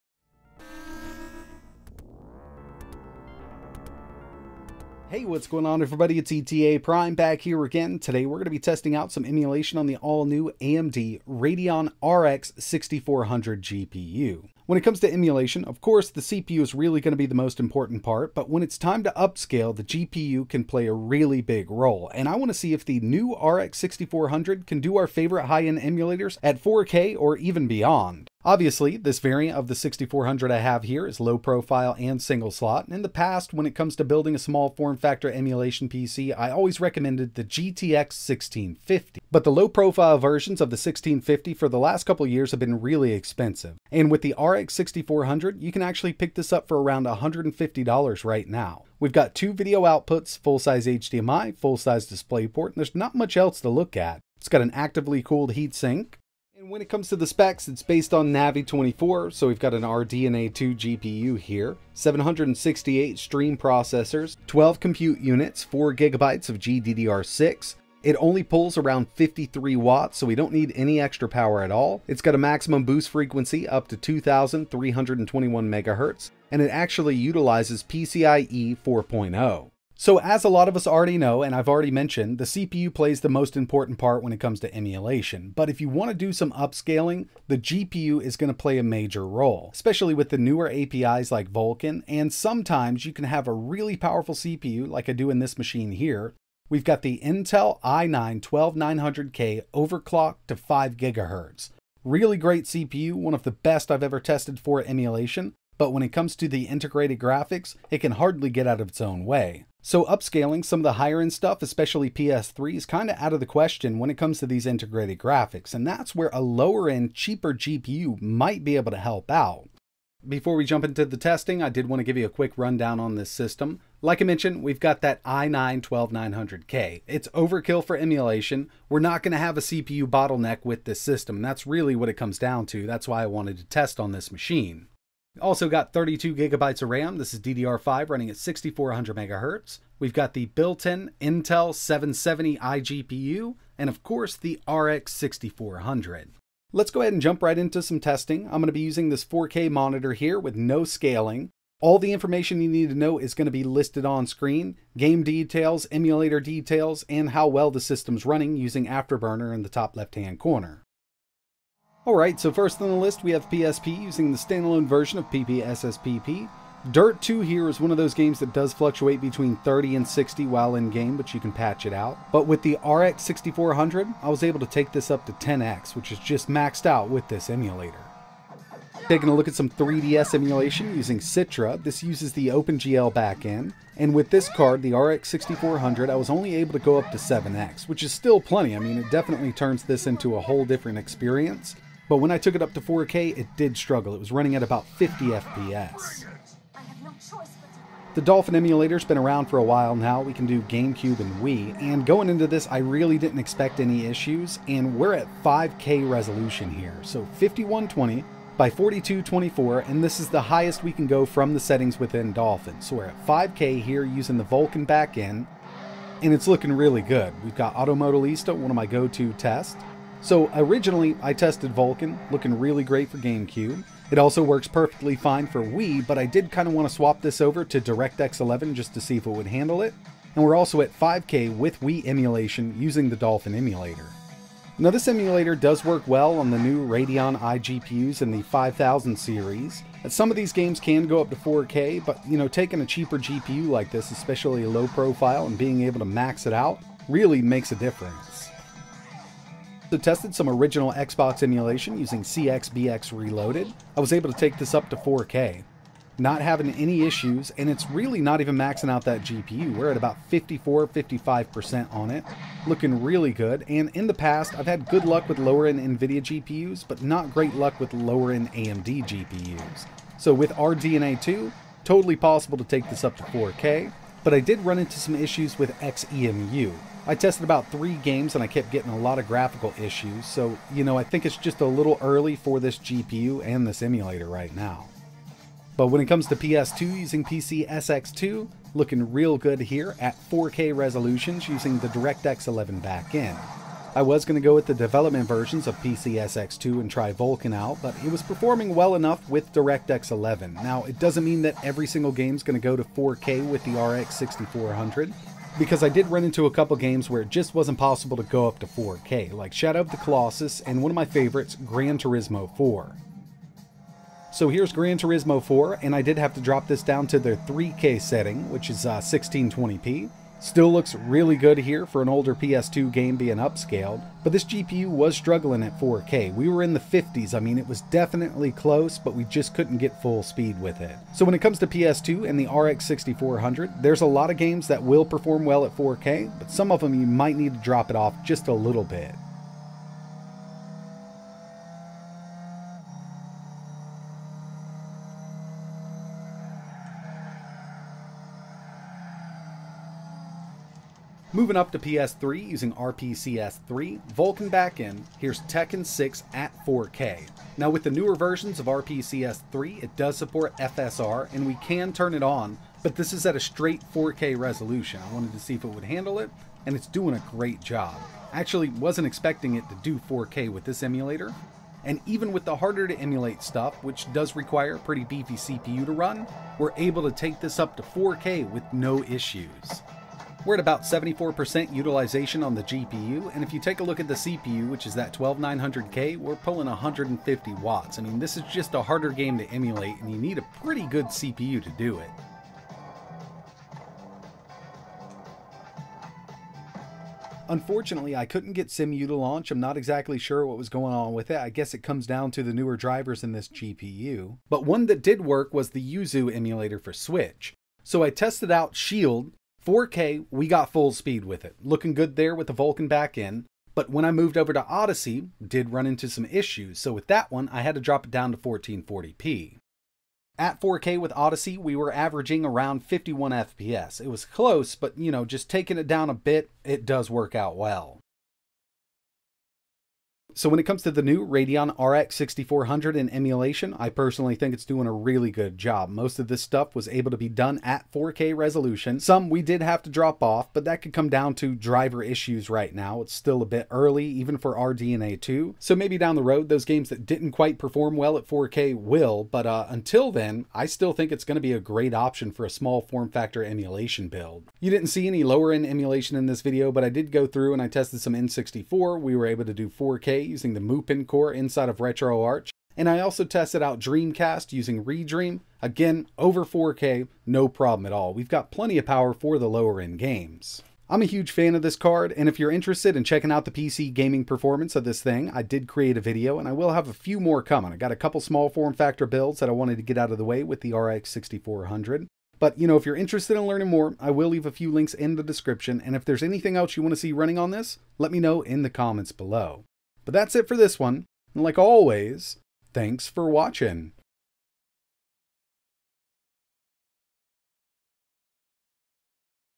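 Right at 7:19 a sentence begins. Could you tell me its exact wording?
Some we did have to drop off, but that could come down to driver issues right now.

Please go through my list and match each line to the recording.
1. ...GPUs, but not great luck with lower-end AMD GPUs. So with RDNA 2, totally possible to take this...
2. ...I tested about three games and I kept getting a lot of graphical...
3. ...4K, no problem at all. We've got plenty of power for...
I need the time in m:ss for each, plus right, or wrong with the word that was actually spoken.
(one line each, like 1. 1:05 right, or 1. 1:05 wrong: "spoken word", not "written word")
1. 4:26 right
2. 4:37 right
3. 7:46 right.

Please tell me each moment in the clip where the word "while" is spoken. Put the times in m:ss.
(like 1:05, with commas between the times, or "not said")
2:50, 3:19.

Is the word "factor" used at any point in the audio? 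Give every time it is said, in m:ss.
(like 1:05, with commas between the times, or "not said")
0:34, 7:33, 7:58.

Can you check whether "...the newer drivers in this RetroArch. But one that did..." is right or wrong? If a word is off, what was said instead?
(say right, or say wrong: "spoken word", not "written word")
wrong: "GPU", not "RetroArch".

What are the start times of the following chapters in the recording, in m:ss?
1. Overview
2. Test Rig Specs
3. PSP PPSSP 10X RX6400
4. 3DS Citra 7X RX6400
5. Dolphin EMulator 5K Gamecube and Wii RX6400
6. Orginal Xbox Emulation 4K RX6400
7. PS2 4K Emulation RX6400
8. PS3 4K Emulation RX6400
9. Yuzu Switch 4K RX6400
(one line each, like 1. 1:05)
1. 0:15
2. 1:29
3. 2:42
4. 2:59
5. 3:18
6. 4:12
7. 4:44
8. 5:53
9. 6:38.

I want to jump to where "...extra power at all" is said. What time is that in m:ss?
1:11.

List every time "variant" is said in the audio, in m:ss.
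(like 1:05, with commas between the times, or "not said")
0:29.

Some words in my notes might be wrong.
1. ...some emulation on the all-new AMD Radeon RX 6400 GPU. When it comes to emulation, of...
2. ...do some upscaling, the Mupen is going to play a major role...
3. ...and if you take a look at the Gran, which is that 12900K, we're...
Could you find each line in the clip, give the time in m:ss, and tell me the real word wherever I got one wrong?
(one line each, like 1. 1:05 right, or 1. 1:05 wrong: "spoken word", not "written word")
1. 0:09 right
2. 1:26 wrong: "GPU", not "Mupen"
3. 6:23 wrong: "CPU", not "Gran".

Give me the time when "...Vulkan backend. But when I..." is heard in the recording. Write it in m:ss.
6:52.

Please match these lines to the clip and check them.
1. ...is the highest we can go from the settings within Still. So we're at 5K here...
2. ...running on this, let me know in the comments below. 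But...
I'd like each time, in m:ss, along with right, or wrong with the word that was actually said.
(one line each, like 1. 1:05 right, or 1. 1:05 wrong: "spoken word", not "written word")
1. 3:30 wrong: "Dolphin", not "Still"
2. 8:07 right.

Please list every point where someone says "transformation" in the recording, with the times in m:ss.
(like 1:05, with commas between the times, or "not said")
not said.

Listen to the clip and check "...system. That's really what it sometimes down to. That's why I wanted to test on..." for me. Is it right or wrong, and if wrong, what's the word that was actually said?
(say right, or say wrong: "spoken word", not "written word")
wrong: "comes", not "sometimes".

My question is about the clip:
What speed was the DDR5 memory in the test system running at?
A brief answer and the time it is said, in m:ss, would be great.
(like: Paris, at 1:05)
6400 megahertz, at 2:18.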